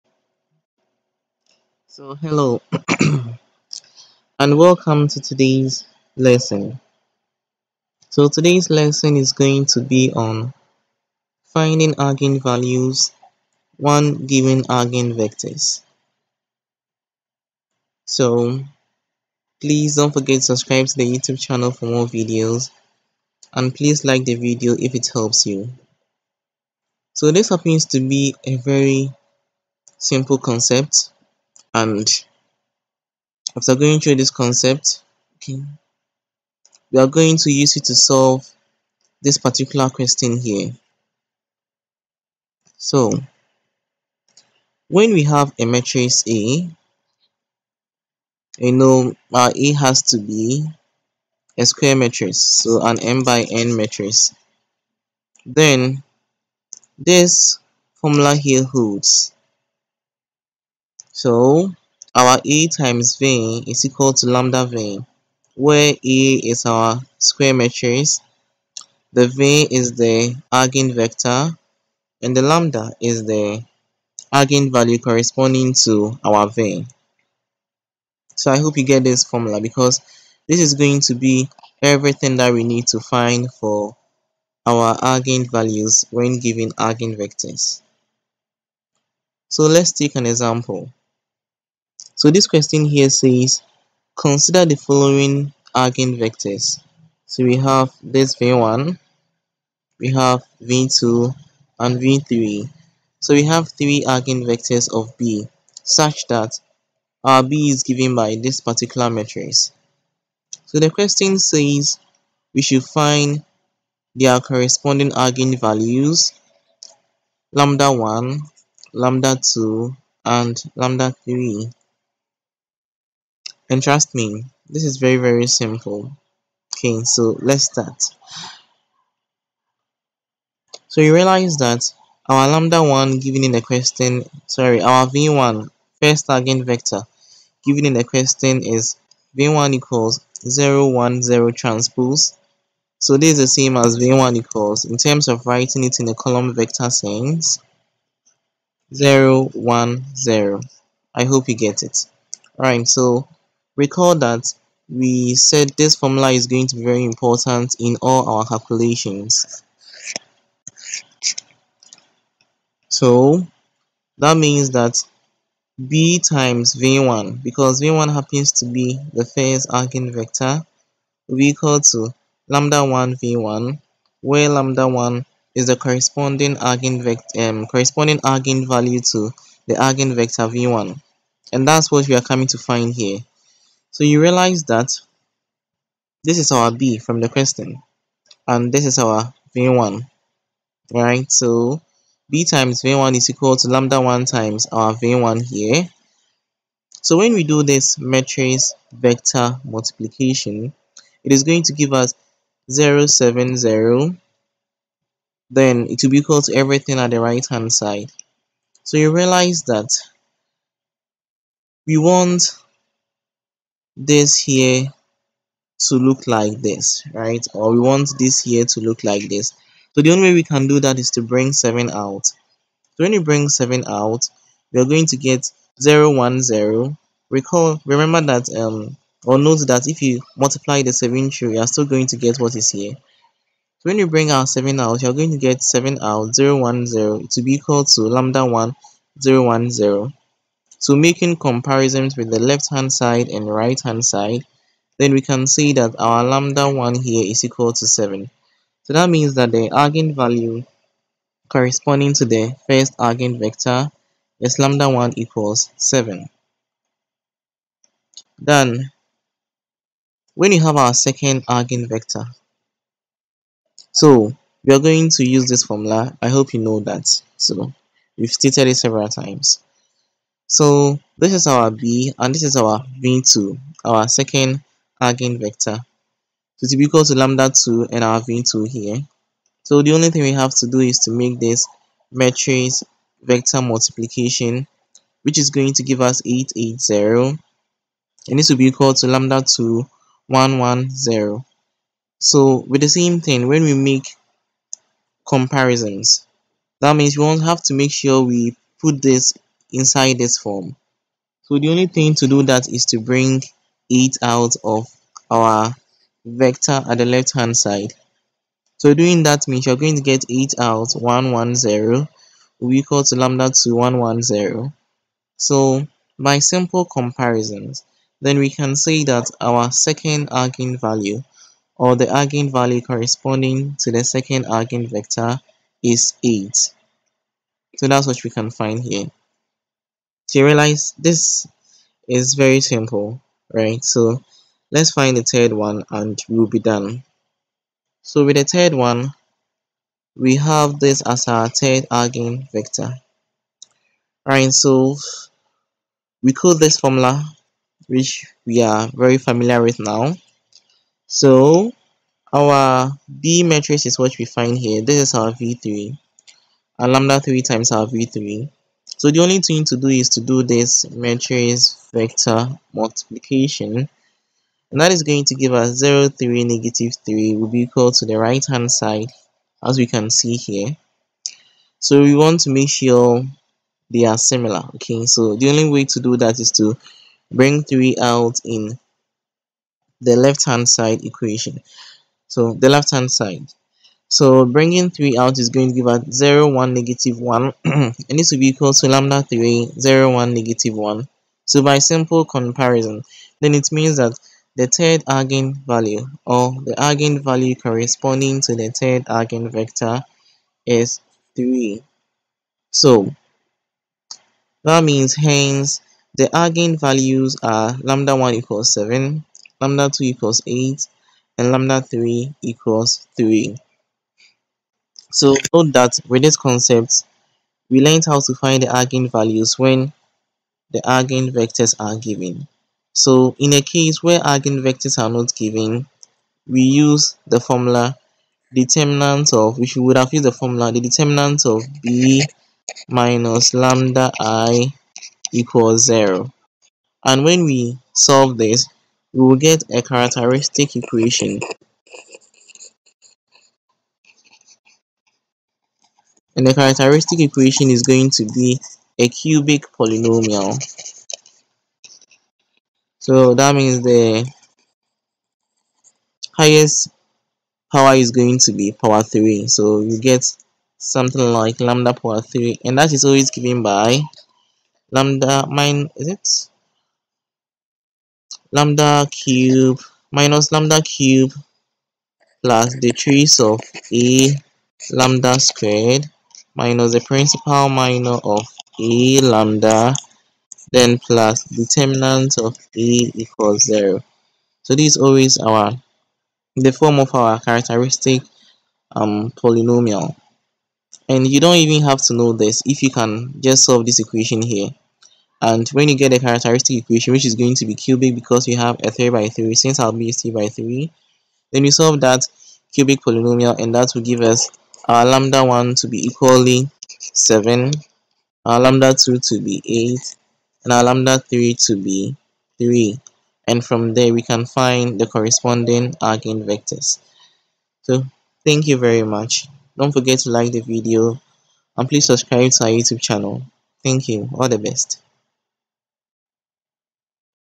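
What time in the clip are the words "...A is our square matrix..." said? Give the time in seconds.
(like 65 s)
65 s.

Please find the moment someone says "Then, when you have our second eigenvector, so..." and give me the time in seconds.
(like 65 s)
258 s.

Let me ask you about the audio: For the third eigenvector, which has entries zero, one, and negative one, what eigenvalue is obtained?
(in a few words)
3.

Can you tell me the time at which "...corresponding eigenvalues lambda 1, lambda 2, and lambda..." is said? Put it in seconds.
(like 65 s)
114 s.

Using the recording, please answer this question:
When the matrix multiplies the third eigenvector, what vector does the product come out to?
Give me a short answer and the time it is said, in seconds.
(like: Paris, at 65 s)
0, 3, -3, at 365 s.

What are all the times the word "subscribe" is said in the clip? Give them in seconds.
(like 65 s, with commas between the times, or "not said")
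20 s, 522 s.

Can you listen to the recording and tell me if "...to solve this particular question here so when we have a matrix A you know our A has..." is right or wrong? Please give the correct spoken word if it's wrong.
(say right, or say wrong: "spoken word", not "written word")
right.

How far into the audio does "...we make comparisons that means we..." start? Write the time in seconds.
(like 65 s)
293 s.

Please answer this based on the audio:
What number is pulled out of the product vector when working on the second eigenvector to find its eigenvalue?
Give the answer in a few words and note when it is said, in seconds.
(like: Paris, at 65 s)
8, at 310 s.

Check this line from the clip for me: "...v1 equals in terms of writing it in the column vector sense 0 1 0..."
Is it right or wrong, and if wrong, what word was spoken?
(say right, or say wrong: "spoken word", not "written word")
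right.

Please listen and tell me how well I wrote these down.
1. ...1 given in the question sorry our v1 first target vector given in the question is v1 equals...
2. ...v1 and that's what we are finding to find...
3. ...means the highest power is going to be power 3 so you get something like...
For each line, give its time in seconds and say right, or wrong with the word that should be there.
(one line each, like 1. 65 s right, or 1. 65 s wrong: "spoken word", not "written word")
1. 132 s right
2. 180 s wrong: "coming", not "finding"
3. 453 s right.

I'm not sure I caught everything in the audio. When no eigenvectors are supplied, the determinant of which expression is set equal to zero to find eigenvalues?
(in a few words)
B minus lambda I.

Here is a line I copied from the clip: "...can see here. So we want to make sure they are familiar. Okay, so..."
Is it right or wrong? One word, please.
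wrong.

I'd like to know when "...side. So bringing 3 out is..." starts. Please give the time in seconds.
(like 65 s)
383 s.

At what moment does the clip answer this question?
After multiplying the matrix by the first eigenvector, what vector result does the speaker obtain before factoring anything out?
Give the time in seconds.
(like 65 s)
202 s.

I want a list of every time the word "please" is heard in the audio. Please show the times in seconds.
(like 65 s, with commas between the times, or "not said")
19 s, 23 s, 521 s.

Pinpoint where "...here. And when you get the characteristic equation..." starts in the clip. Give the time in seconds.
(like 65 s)
494 s.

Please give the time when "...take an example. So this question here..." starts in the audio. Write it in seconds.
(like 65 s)
89 s.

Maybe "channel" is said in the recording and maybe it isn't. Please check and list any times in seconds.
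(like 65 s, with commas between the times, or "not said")
21 s, 523 s.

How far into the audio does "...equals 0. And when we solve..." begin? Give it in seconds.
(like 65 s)
435 s.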